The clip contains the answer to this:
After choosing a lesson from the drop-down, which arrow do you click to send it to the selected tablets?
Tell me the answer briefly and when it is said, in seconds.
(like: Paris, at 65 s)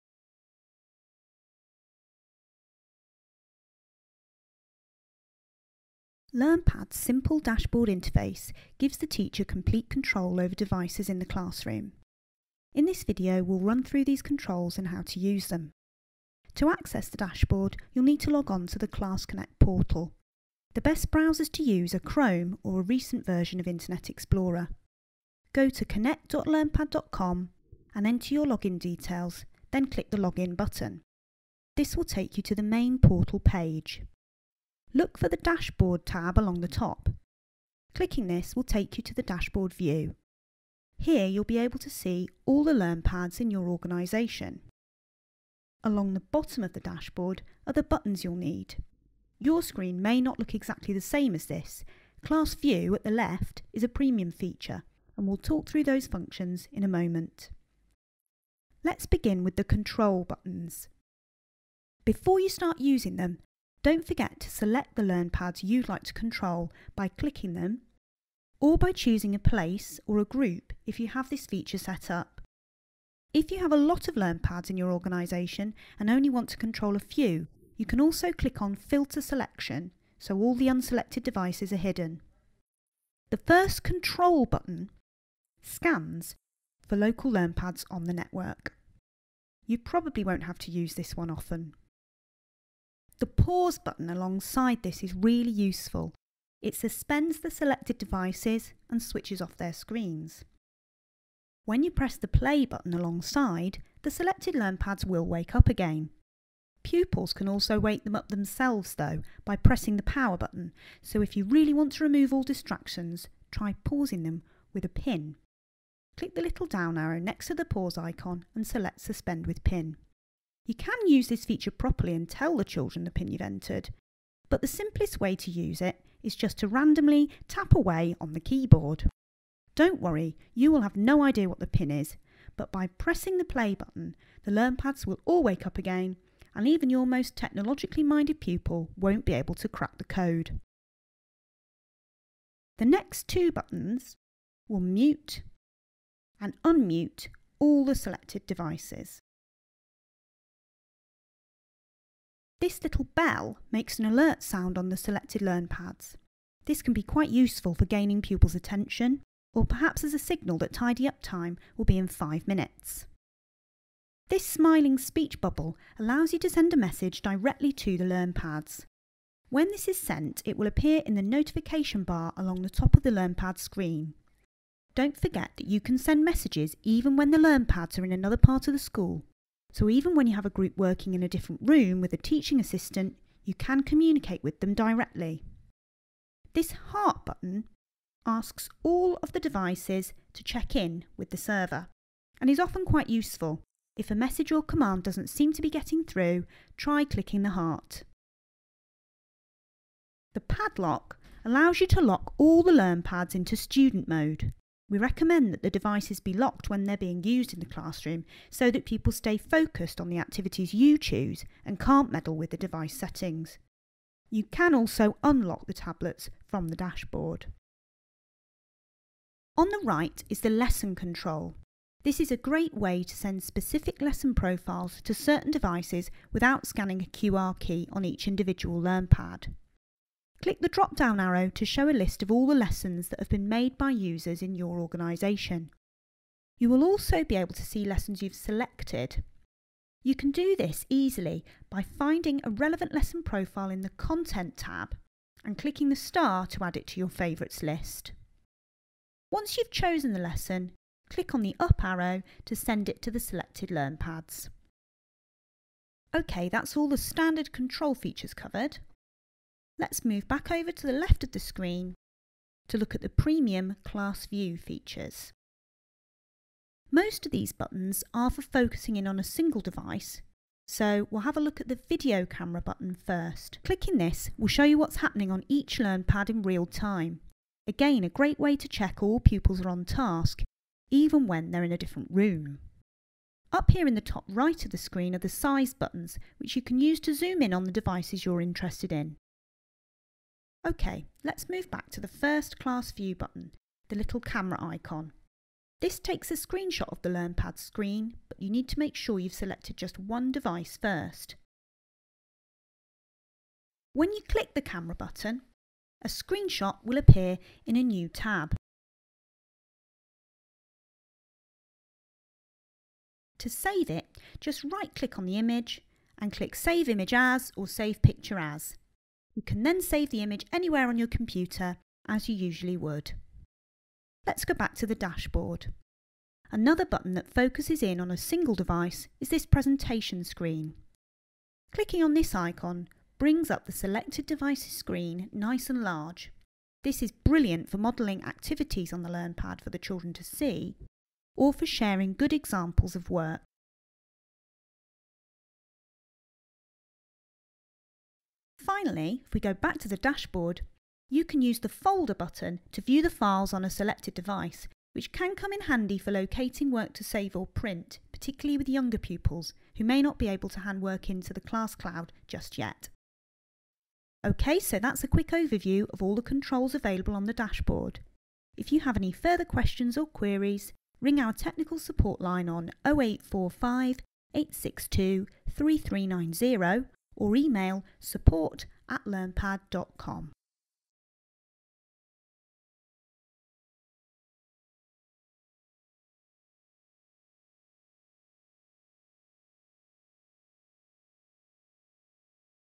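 up arrow, at 251 s.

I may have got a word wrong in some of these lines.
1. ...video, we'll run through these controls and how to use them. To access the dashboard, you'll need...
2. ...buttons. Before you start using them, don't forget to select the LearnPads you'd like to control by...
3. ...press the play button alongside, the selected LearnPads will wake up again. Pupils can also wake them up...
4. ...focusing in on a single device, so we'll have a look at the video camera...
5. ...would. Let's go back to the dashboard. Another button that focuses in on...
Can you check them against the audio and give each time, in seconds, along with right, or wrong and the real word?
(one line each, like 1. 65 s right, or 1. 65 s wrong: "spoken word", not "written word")
1. 13 s right
2. 60 s right
3. 101 s right
4. 268 s right
5. 322 s right.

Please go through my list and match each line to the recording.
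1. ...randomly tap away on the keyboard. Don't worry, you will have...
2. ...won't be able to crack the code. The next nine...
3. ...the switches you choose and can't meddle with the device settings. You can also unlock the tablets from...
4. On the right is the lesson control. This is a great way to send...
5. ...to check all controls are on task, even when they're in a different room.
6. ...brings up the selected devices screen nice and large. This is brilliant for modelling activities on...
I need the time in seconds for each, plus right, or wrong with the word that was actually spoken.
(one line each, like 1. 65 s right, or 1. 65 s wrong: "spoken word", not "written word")
1. 126 s right
2. 138 s wrong: "two", not "nine"
3. 210 s wrong: "activities", not "switches"
4. 219 s right
5. 278 s wrong: "pupils", not "controls"
6. 333 s right.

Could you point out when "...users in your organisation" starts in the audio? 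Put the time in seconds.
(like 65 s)
233 s.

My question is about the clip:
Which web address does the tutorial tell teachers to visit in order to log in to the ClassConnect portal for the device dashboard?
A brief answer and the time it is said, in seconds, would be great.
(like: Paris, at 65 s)
connect.learnpad.com, at 25 s.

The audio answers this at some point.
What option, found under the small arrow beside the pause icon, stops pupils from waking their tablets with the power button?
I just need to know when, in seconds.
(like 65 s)
118 s.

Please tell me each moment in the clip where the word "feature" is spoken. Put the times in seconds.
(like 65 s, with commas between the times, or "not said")
54 s, 71 s, 121 s, 257 s, 264 s.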